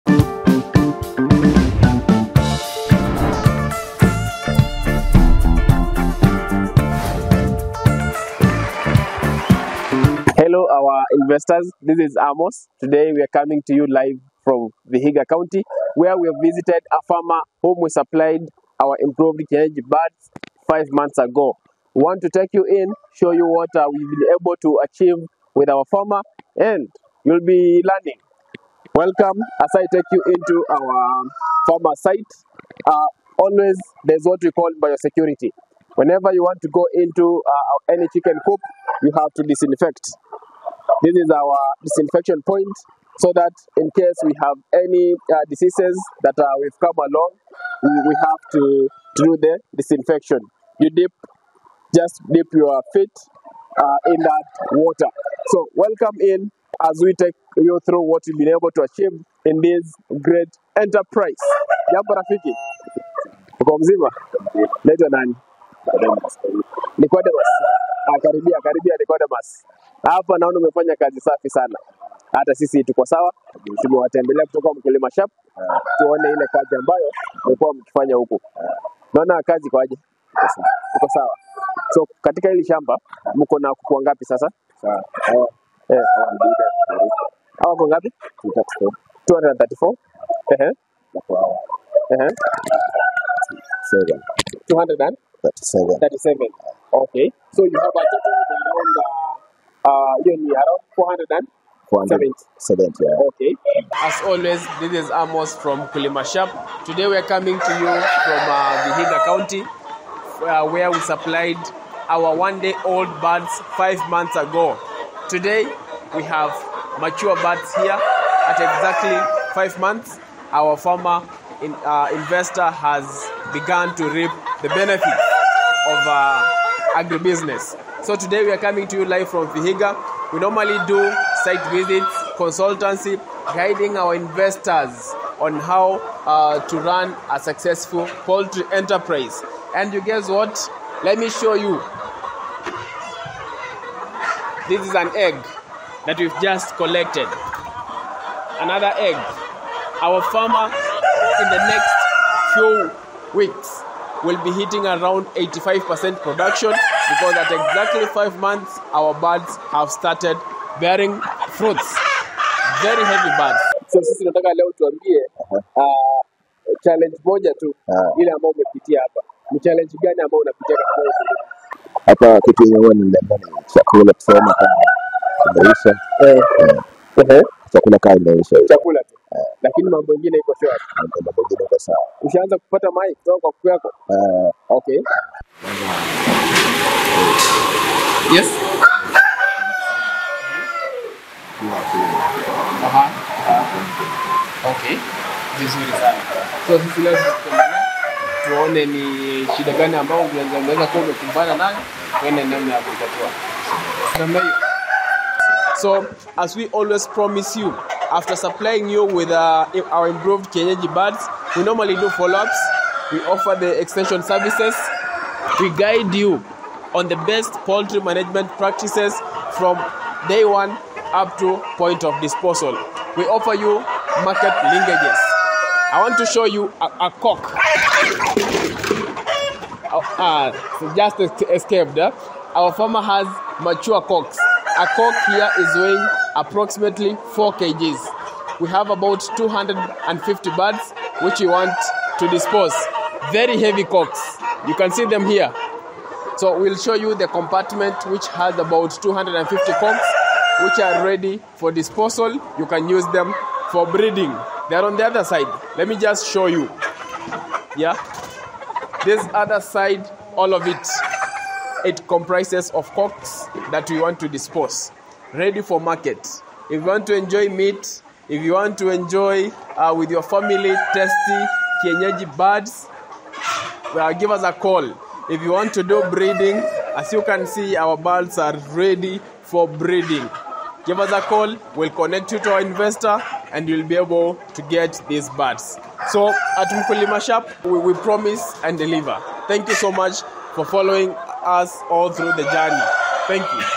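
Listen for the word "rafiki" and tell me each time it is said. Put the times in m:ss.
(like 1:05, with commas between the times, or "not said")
1:02.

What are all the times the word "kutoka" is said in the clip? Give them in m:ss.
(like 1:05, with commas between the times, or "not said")
1:14, 3:03.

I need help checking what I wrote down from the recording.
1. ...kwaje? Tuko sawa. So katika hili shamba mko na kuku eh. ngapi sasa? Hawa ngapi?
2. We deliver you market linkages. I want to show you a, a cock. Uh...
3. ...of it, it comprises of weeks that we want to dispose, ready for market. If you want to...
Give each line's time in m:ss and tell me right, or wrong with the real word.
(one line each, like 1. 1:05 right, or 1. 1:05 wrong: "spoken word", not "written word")
1. 1:19 right
2. 3:43 wrong: "offer", not "deliver"
3. 4:20 wrong: "cocks", not "weeks".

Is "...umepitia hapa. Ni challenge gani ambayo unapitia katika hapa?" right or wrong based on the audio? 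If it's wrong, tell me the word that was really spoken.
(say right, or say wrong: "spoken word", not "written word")
right.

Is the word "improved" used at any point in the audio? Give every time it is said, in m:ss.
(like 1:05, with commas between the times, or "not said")
0:18, 3:30.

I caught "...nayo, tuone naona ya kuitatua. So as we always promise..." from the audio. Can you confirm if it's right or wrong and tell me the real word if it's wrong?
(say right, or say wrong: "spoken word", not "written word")
wrong: "namna", not "naona".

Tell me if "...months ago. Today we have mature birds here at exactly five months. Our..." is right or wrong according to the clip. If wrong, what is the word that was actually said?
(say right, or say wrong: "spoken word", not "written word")
right.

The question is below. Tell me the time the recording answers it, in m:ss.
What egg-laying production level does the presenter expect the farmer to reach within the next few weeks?
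2:35.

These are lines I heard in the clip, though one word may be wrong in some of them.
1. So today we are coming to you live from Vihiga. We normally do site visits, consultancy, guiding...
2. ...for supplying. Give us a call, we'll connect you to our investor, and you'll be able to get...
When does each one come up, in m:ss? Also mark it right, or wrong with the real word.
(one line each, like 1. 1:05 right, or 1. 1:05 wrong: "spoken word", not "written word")
1. 2:08 right
2. 4:39 wrong: "breeding", not "supplying".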